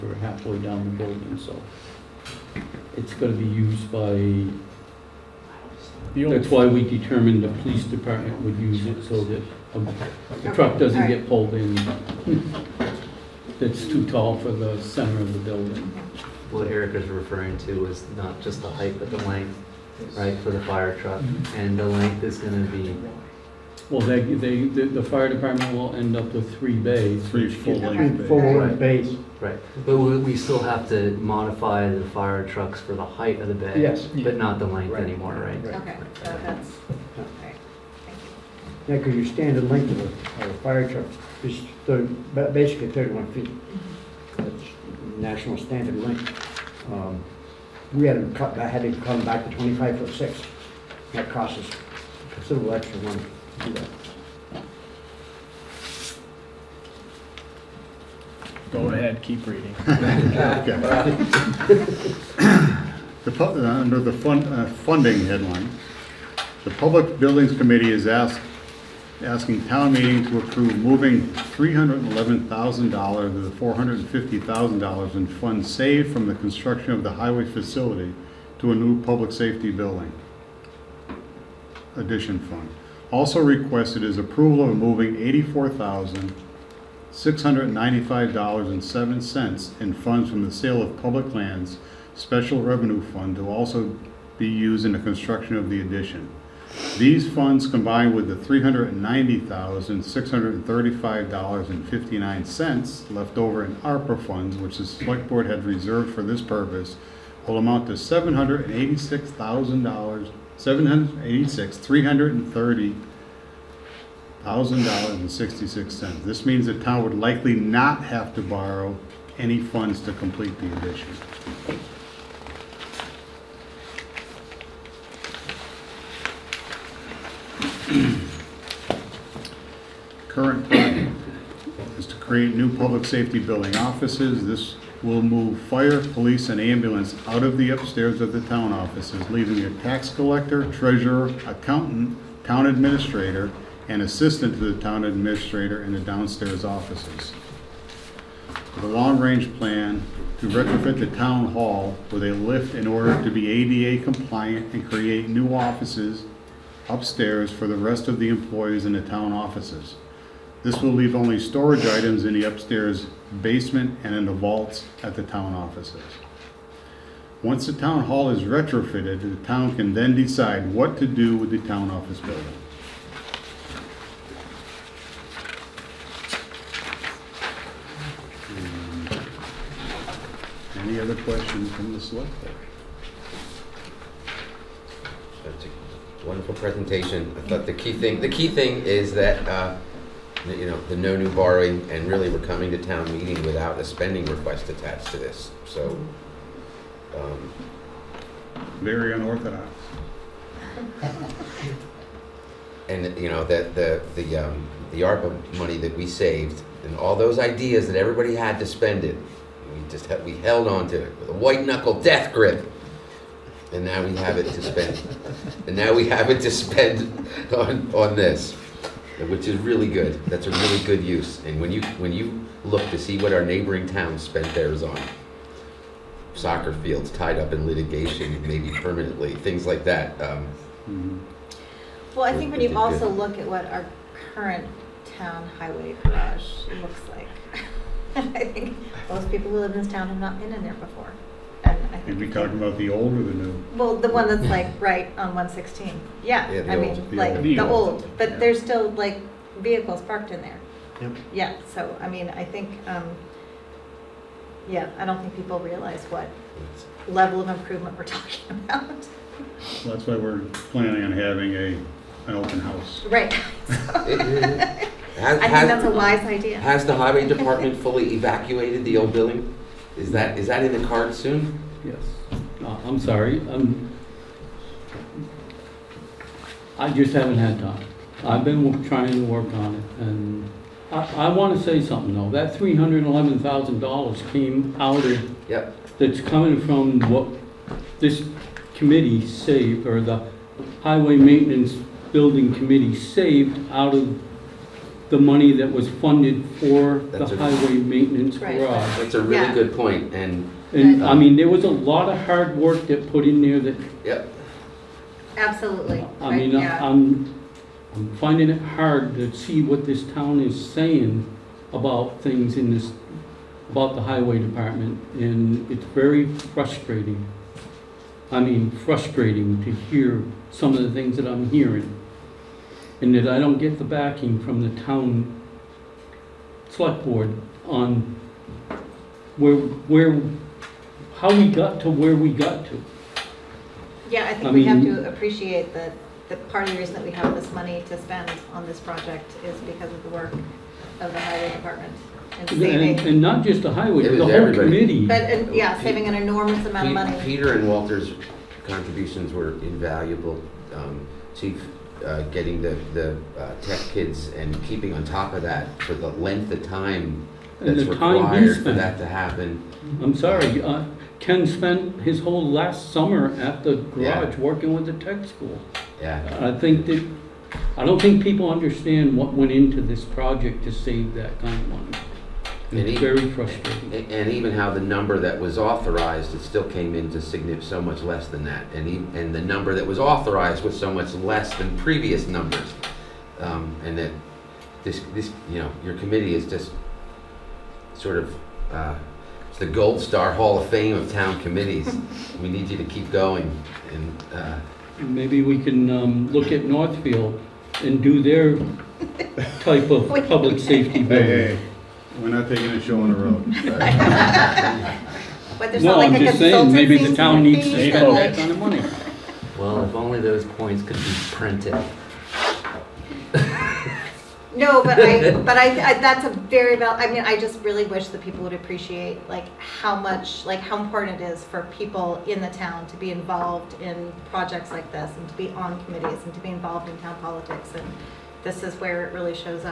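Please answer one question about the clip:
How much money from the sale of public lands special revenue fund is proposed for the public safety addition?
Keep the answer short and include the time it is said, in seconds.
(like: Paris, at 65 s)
$84,695.07, at 85 s.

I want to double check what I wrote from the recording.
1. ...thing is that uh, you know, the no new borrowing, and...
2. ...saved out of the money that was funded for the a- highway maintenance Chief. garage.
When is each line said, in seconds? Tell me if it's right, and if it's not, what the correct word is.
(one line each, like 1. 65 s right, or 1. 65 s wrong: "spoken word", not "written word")
1. 188 s right
2. 292 s wrong: "Right", not "Chief".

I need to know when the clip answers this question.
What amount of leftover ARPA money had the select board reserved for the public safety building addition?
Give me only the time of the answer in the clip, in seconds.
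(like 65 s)
98 s.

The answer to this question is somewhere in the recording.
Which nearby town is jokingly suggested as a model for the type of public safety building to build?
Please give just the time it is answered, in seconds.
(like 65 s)
396 s.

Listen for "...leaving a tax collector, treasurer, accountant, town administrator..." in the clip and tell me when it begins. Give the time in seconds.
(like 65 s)
139 s.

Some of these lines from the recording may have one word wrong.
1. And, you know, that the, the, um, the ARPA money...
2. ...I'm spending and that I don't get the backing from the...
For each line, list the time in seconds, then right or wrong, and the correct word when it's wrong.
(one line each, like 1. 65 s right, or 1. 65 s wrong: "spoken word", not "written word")
1. 202 s right
2. 321 s wrong: "hearing", not "spending".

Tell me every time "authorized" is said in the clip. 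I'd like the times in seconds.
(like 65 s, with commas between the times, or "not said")
375 s, 379 s.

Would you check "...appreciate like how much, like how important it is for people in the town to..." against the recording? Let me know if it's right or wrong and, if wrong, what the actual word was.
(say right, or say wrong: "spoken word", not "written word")
right.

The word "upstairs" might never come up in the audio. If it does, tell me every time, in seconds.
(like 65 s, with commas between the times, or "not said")
137 s, 156 s, 162 s.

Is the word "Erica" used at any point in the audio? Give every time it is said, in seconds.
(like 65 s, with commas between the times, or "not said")
16 s.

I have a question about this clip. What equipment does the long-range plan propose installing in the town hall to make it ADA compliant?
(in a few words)
A lift.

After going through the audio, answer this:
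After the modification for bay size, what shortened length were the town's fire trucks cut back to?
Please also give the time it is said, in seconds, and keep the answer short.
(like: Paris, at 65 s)
25 feet 6 inches, at 49 s.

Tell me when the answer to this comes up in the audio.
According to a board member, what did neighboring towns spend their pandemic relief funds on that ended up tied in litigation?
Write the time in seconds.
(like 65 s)
226 s.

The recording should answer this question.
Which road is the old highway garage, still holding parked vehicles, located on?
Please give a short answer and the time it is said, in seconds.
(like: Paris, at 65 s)
Route 116, at 245 s.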